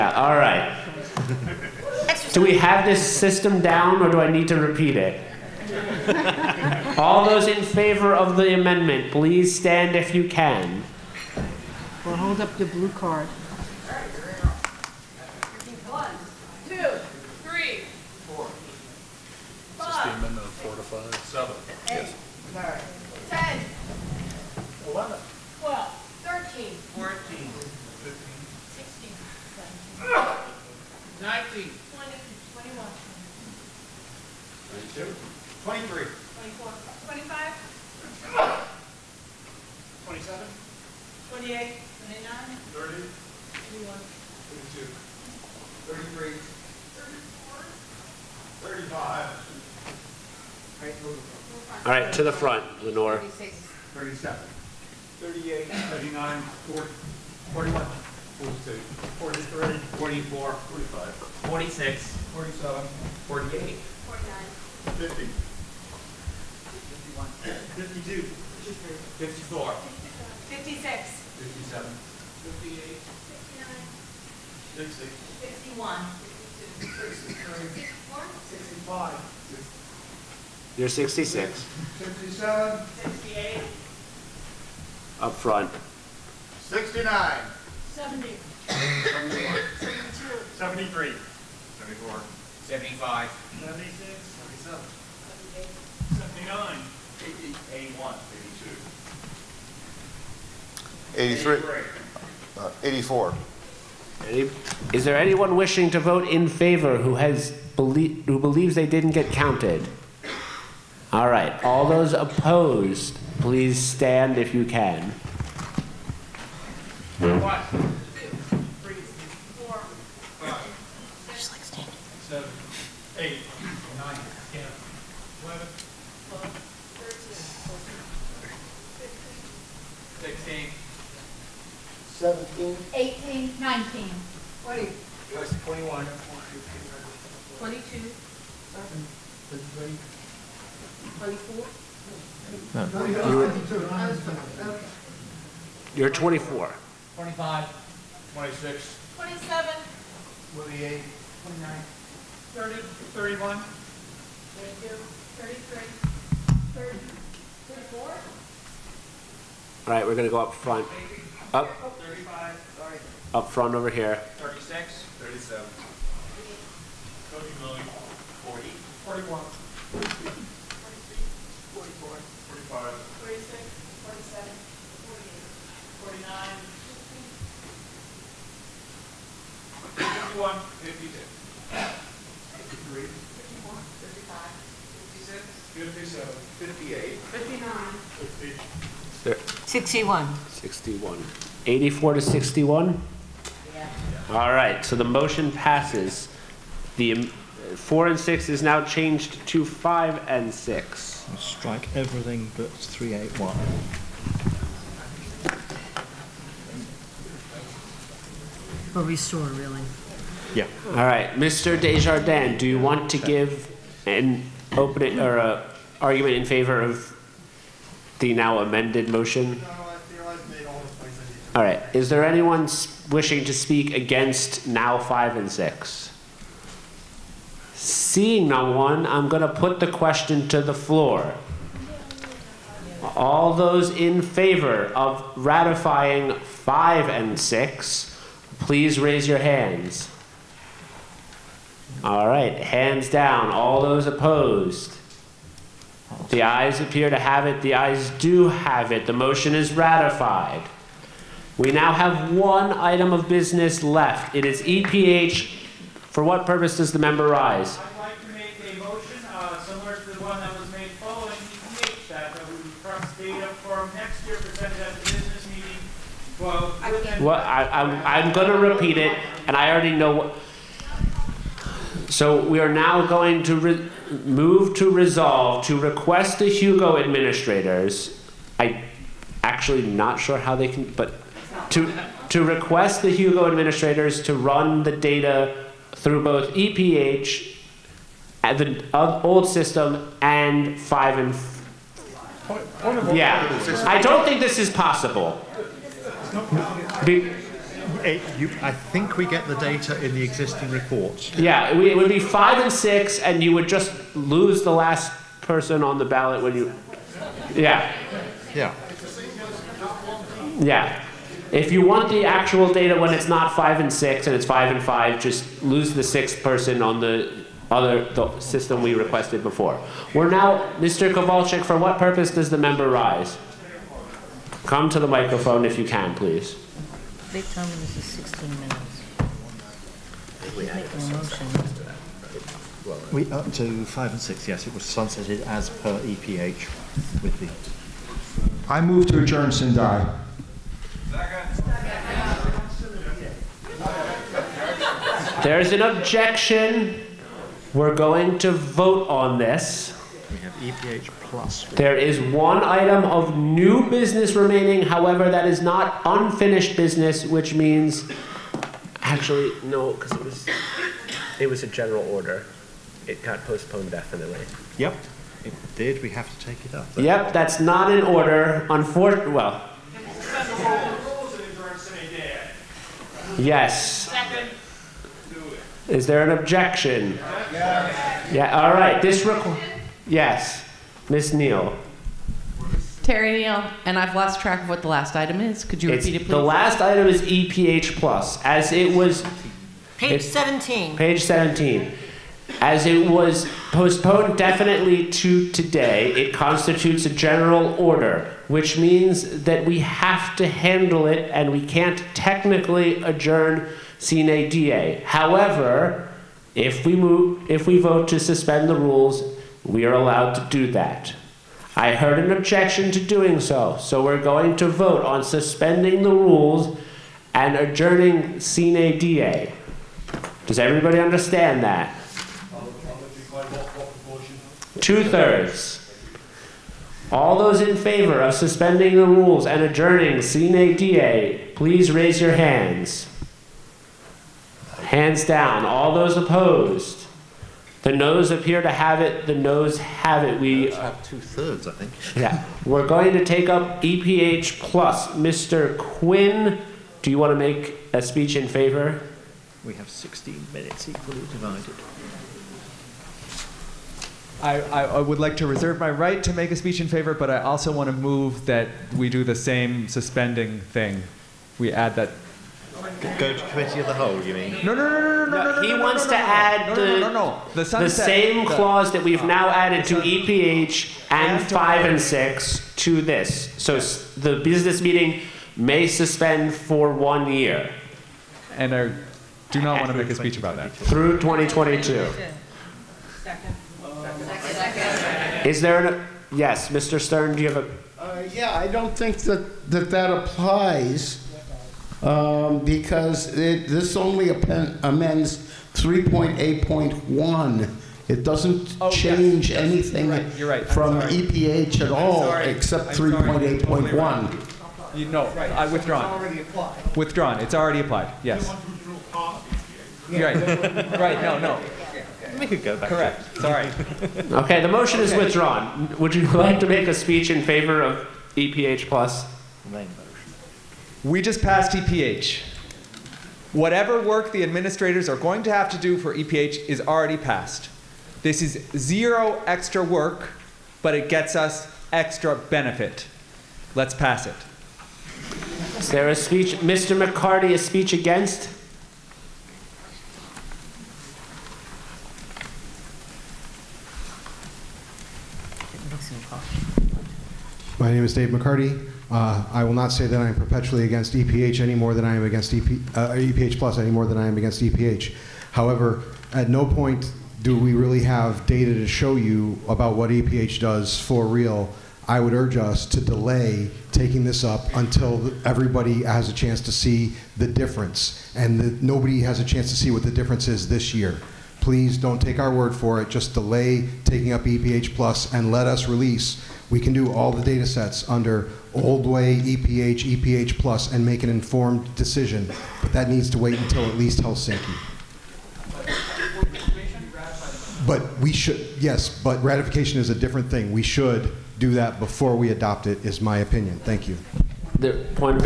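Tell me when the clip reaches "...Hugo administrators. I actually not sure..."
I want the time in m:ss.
4:36.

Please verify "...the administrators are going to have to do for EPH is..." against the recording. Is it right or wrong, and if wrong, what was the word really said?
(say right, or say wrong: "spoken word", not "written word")
right.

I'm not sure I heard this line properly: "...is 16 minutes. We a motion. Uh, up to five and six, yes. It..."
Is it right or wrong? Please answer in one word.
right.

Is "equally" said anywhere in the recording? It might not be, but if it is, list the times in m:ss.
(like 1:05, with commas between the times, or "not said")
7:30.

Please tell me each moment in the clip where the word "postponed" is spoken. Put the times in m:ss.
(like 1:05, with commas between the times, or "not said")
6:03, 6:33.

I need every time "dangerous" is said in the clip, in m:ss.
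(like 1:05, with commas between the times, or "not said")
not said.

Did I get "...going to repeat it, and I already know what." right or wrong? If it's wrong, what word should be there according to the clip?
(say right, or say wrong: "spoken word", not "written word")
right.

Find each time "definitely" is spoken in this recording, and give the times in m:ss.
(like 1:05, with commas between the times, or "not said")
6:03, 6:34.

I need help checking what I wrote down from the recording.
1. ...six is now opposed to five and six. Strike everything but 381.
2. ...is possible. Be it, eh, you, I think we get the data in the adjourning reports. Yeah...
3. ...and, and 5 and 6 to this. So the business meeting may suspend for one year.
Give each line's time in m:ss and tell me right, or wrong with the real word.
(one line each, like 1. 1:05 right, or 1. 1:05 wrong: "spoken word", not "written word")
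1. 3:18 wrong: "changed", not "opposed"
2. 4:54 wrong: "existing", not "adjourning"
3. 7:51 right.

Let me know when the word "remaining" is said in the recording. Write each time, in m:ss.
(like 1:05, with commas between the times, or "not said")
5:54.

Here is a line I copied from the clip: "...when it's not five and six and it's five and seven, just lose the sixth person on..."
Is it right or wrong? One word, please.
wrong.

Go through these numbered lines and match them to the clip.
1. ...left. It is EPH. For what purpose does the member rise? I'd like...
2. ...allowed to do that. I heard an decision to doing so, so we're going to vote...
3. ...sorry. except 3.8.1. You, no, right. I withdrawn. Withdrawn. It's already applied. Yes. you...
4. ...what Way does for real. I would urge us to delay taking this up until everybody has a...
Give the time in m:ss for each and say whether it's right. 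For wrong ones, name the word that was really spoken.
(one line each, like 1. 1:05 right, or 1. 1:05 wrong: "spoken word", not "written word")
1. 4:13 right
2. 6:49 wrong: "objection", not "decision"
3. 8:22 right
4. 9:19 wrong: "EPH", not "Way".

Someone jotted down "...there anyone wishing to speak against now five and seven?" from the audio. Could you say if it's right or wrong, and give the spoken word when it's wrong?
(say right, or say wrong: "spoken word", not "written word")
wrong: "six", not "seven".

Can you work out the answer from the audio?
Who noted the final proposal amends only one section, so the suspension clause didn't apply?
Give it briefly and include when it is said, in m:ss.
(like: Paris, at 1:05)
Mr. Stern, at 8:06.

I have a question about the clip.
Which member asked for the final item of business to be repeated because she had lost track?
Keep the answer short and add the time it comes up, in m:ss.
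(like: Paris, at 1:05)
Terry Neal, at 6:23.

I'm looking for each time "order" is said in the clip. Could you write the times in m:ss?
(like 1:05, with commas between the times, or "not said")
6:02, 6:08, 6:37.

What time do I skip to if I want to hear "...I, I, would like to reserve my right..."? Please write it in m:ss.
7:34.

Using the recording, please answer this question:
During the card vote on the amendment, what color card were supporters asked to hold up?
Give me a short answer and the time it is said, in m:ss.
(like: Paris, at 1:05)
blue, at 0:12.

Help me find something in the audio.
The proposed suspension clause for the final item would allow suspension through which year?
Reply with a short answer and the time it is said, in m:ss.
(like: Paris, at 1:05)
2022, at 8:01.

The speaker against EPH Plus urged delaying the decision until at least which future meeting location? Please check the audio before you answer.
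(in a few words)
Helsinki.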